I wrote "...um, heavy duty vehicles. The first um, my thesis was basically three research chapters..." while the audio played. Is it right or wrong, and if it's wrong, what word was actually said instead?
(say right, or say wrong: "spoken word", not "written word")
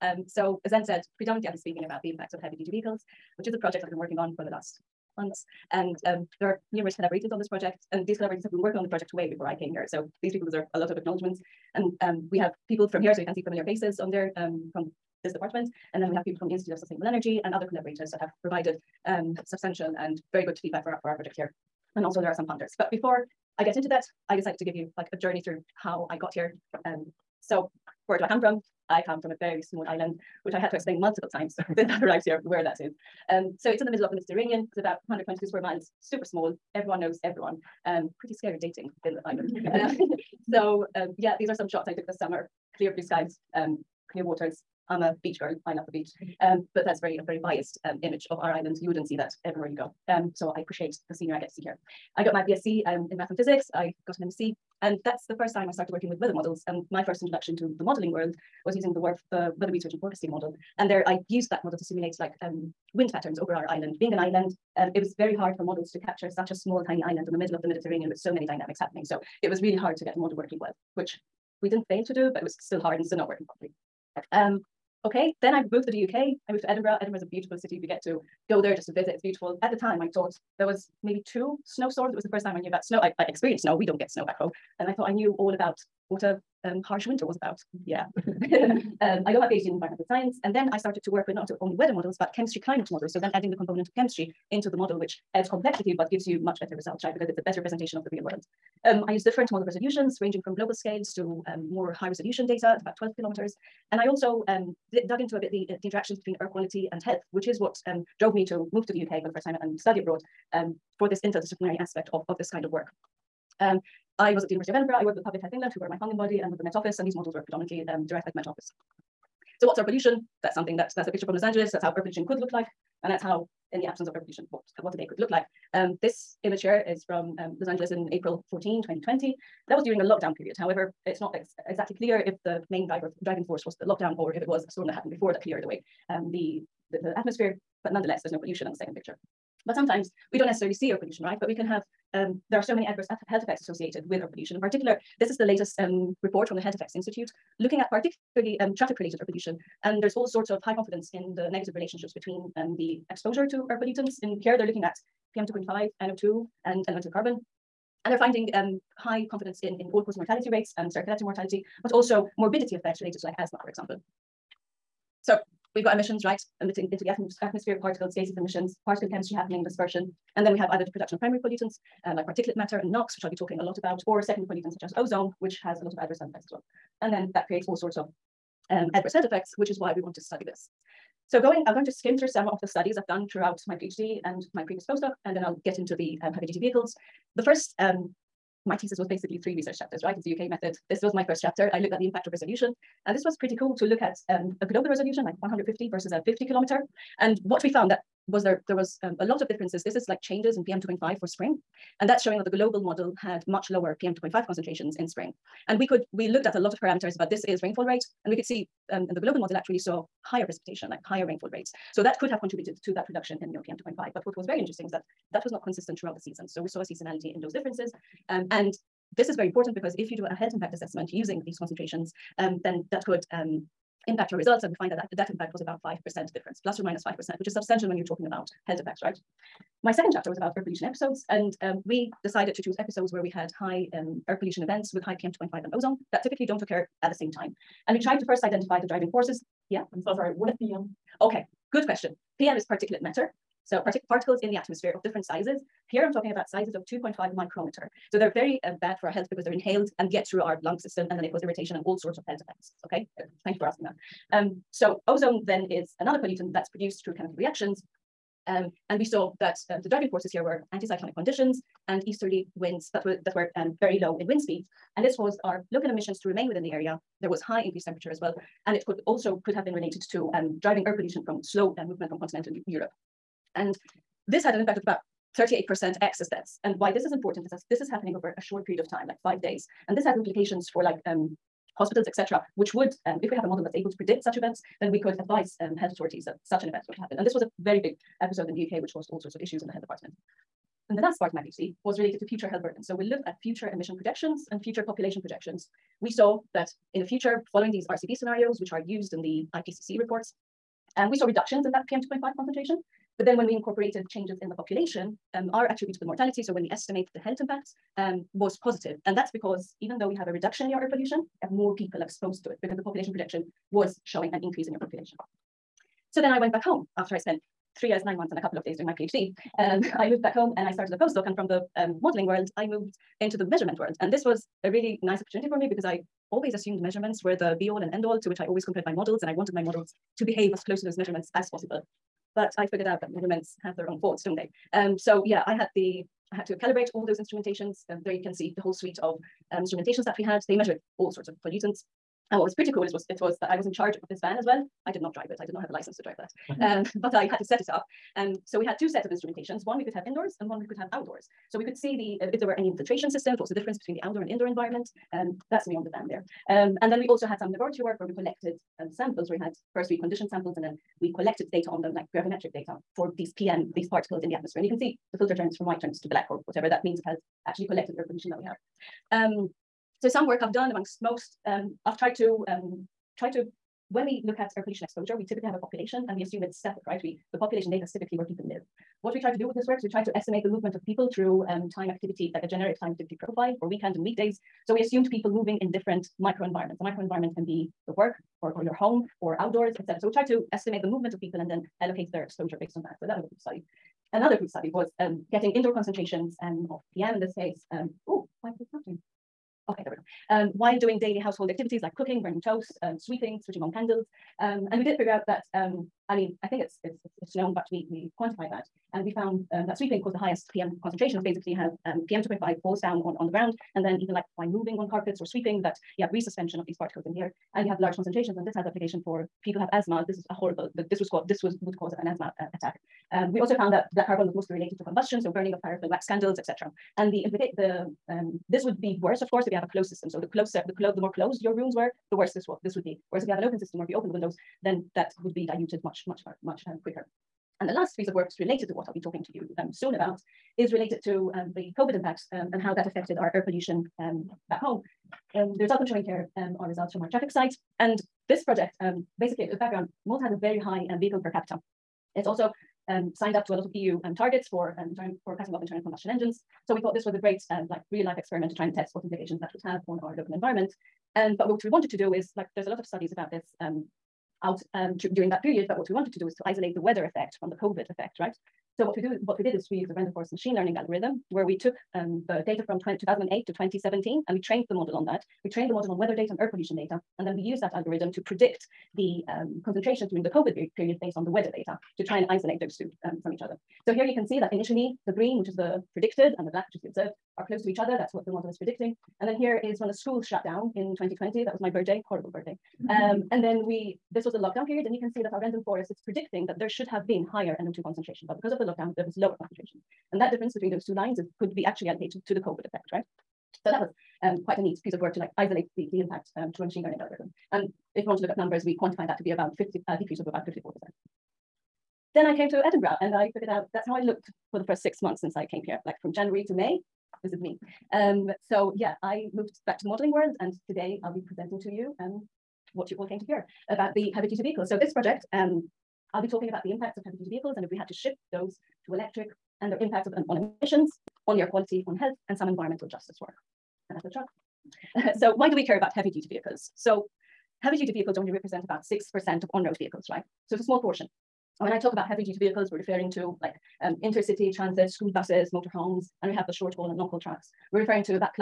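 right.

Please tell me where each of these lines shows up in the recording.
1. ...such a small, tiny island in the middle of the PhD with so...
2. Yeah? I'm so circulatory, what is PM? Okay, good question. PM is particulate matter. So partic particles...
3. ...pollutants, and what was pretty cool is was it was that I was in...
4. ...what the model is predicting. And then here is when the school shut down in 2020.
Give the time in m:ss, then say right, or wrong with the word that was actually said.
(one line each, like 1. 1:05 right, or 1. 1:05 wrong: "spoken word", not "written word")
1. 1:06 wrong: "Mediterranean", not "PhD"
2. 3:59 wrong: "sorry", not "circulatory"
3. 5:41 right
4. 8:08 right.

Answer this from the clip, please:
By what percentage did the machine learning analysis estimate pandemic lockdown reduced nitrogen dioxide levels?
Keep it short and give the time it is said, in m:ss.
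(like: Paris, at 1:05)
54%, at 8:30.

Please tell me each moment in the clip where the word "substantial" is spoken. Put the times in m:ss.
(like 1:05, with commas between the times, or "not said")
0:19, 3:47.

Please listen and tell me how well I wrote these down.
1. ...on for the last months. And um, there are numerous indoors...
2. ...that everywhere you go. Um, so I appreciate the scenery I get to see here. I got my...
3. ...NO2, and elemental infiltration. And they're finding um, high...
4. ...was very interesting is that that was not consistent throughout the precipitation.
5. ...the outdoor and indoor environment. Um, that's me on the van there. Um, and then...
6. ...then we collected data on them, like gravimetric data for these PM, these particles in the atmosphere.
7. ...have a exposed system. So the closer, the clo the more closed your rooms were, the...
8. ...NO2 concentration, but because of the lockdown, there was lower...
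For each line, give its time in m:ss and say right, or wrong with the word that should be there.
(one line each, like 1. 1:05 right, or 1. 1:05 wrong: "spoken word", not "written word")
1. 0:04 wrong: "collaborators", not "indoors"
2. 0:49 right
3. 2:36 wrong: "carbon", not "infiltration"
4. 3:34 wrong: "season", not "precipitation"
5. 5:53 right
6. 6:00 right
7. 7:09 wrong: "closed", not "exposed"
8. 8:17 right.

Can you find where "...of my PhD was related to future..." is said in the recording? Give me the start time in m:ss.
4:51.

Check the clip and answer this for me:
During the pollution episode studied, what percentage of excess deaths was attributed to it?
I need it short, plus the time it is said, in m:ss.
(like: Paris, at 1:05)
38%, at 4:35.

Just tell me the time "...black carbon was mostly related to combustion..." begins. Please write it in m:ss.
7:03.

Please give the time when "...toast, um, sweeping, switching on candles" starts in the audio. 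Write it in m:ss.
6:42.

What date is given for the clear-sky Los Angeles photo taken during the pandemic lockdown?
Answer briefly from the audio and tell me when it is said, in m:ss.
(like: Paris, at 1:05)
April 14, 2020, at 2:08.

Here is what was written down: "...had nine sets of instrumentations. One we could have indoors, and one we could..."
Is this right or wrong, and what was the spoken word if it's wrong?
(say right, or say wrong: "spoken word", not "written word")
wrong: "two", not "nine".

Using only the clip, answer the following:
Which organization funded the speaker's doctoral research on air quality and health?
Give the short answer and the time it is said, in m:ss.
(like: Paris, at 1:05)
Public Health England, at 1:55.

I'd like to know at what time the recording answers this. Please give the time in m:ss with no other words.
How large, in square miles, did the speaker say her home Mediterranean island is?
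0:35.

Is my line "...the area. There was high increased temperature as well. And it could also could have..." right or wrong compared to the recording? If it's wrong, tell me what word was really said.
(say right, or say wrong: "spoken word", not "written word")
right.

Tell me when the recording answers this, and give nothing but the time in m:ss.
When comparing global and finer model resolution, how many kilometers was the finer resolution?
3:16.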